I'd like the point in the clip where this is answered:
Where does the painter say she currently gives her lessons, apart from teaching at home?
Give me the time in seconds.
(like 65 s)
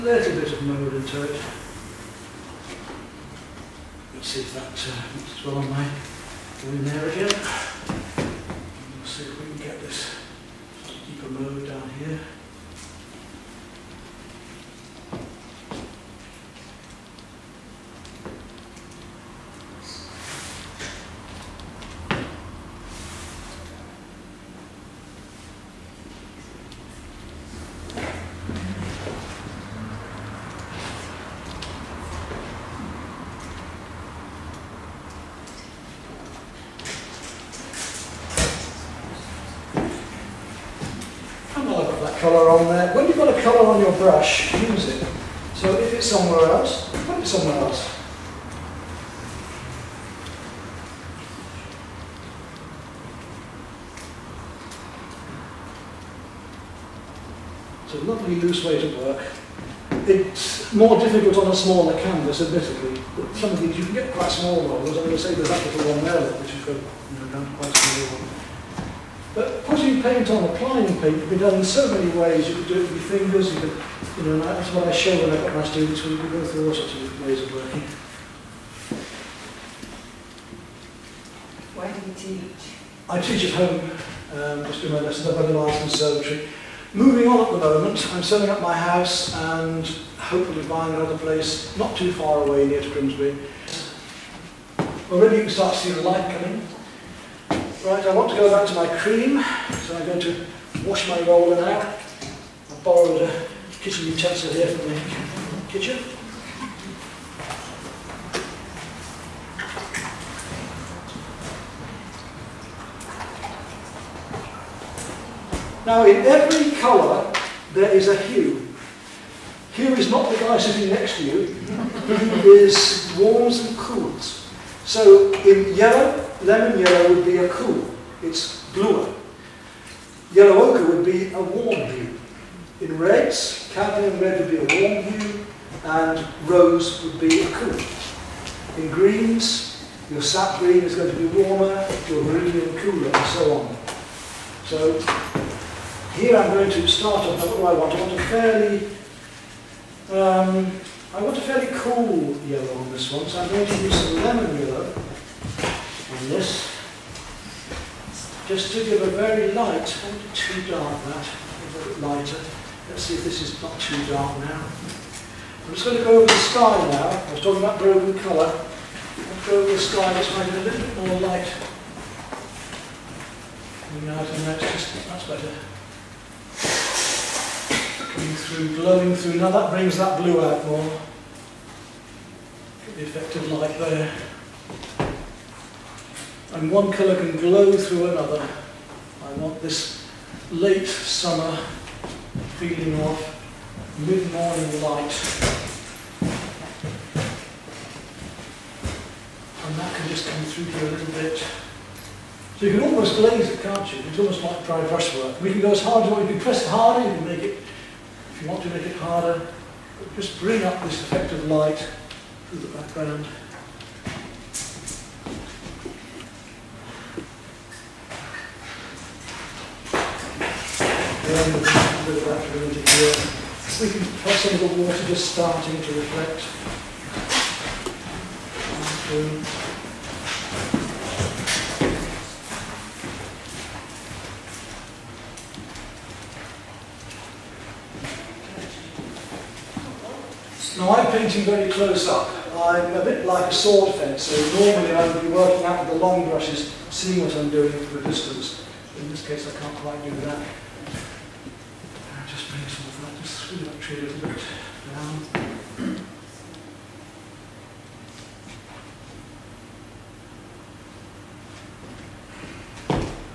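85 s.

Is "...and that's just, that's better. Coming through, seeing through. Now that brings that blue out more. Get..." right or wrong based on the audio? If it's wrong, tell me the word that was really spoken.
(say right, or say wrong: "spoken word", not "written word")
wrong: "glowing", not "seeing".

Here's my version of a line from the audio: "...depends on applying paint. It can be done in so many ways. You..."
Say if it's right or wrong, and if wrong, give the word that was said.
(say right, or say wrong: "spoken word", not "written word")
right.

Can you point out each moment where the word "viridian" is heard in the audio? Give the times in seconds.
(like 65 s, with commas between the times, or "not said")
142 s.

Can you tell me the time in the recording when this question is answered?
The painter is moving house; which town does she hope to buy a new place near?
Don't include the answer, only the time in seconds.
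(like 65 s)
92 s.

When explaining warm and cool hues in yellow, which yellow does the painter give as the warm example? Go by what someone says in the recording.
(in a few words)
Yellow ochre.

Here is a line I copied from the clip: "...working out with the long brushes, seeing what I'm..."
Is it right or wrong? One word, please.
right.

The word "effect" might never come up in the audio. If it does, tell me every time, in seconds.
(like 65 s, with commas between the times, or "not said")
183 s, 211 s.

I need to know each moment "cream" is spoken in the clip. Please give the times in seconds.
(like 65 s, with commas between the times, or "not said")
98 s.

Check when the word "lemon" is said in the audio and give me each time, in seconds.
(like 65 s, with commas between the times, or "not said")
126 s, 154 s.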